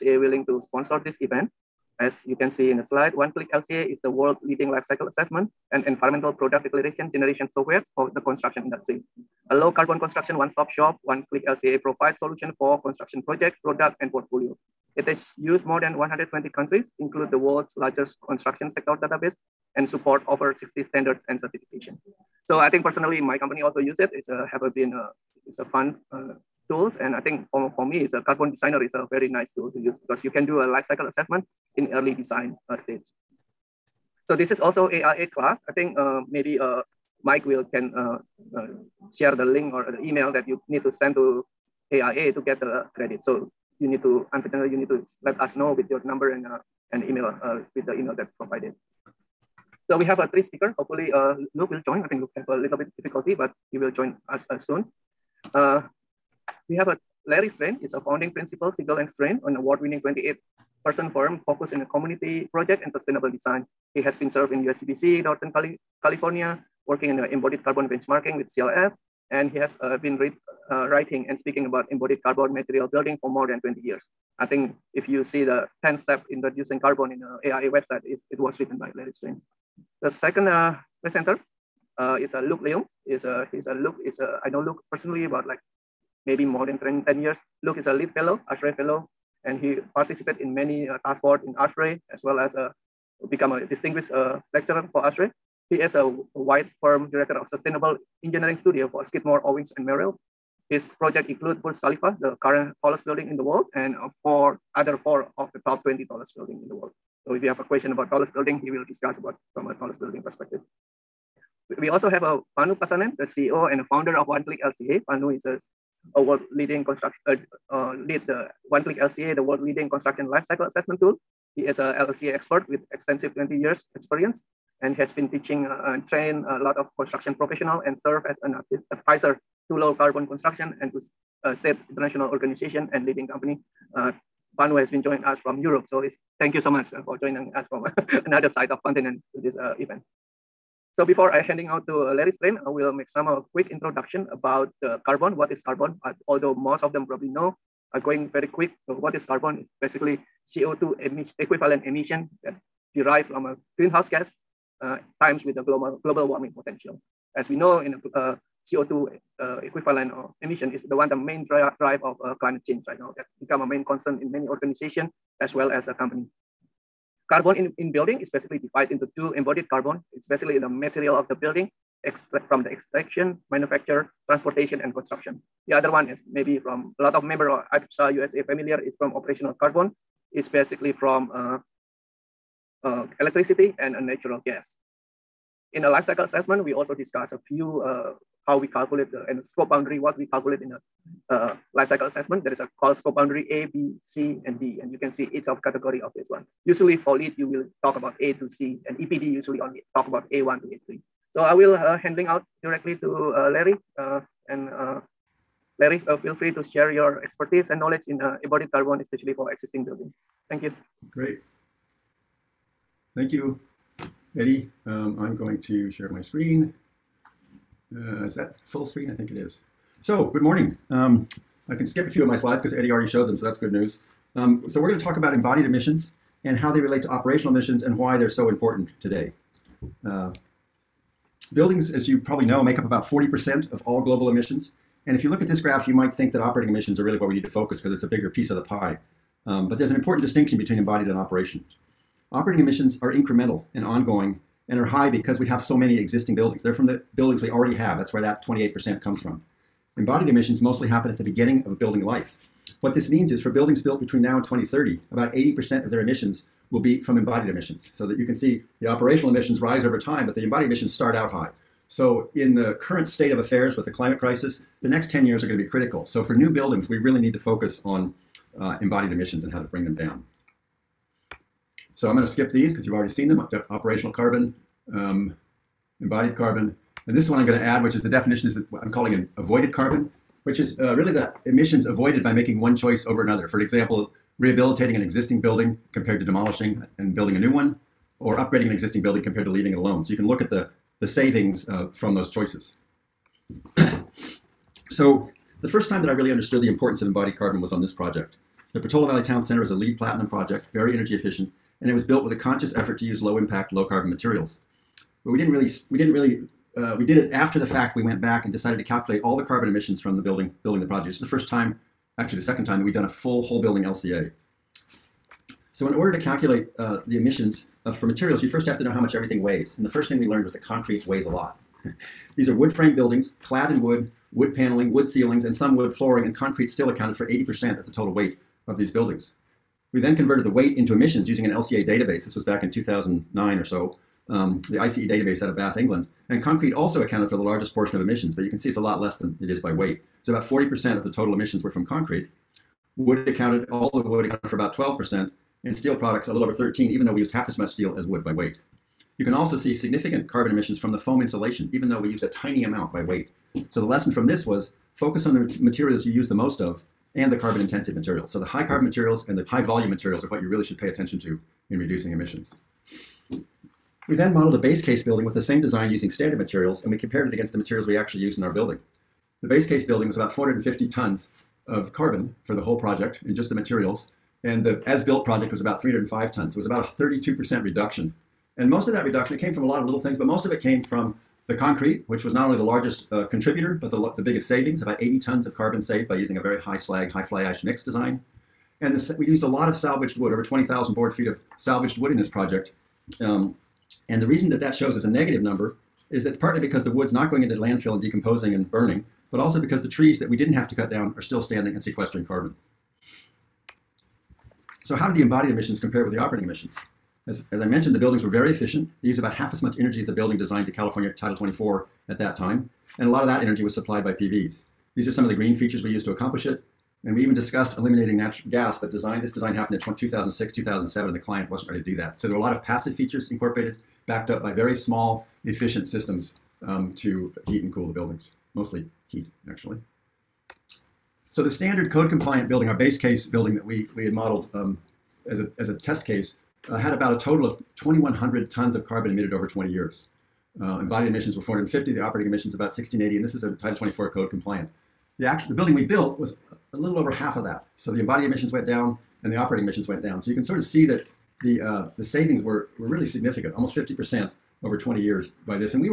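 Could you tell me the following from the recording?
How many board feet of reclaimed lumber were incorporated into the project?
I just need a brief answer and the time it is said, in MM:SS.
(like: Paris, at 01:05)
20,000, at 06:30.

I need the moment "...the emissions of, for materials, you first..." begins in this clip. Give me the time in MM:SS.
05:17.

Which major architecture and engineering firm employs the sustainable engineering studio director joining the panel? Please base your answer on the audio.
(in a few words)
Skidmore, Owings, and Merrill.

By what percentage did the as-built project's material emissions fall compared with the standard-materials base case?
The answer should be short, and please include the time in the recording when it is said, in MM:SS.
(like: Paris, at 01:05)
32%, at 06:17.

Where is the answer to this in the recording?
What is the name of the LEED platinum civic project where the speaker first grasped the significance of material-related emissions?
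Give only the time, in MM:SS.
04:58.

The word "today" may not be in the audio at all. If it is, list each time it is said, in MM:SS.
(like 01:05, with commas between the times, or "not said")
03:49.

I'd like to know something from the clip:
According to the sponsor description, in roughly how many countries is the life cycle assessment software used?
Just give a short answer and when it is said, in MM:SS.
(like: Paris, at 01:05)
120, at 00:15.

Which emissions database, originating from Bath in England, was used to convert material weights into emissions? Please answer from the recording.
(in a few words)
ICE database.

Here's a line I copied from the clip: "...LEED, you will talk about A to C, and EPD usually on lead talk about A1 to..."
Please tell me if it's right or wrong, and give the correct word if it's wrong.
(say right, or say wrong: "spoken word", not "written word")
right.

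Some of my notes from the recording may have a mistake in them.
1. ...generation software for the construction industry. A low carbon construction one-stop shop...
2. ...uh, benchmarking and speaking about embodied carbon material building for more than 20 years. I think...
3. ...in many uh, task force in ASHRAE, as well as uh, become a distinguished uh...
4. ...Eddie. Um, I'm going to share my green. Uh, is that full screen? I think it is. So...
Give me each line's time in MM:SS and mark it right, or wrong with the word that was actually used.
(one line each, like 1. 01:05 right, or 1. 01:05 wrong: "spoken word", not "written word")
1. 00:07 right
2. 01:10 wrong: "writing", not "benchmarking"
3. 01:30 right
4. 03:34 wrong: "screen", not "green".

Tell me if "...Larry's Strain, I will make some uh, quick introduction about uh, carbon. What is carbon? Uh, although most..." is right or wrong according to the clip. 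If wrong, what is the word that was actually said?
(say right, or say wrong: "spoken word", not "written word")
right.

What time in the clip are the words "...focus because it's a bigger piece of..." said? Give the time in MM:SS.
03:57.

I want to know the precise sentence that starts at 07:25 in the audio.
The, actual the building we built was a little over half of that.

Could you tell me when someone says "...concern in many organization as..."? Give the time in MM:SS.
02:43.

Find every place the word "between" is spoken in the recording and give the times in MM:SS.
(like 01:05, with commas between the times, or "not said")
04:00, 04:13.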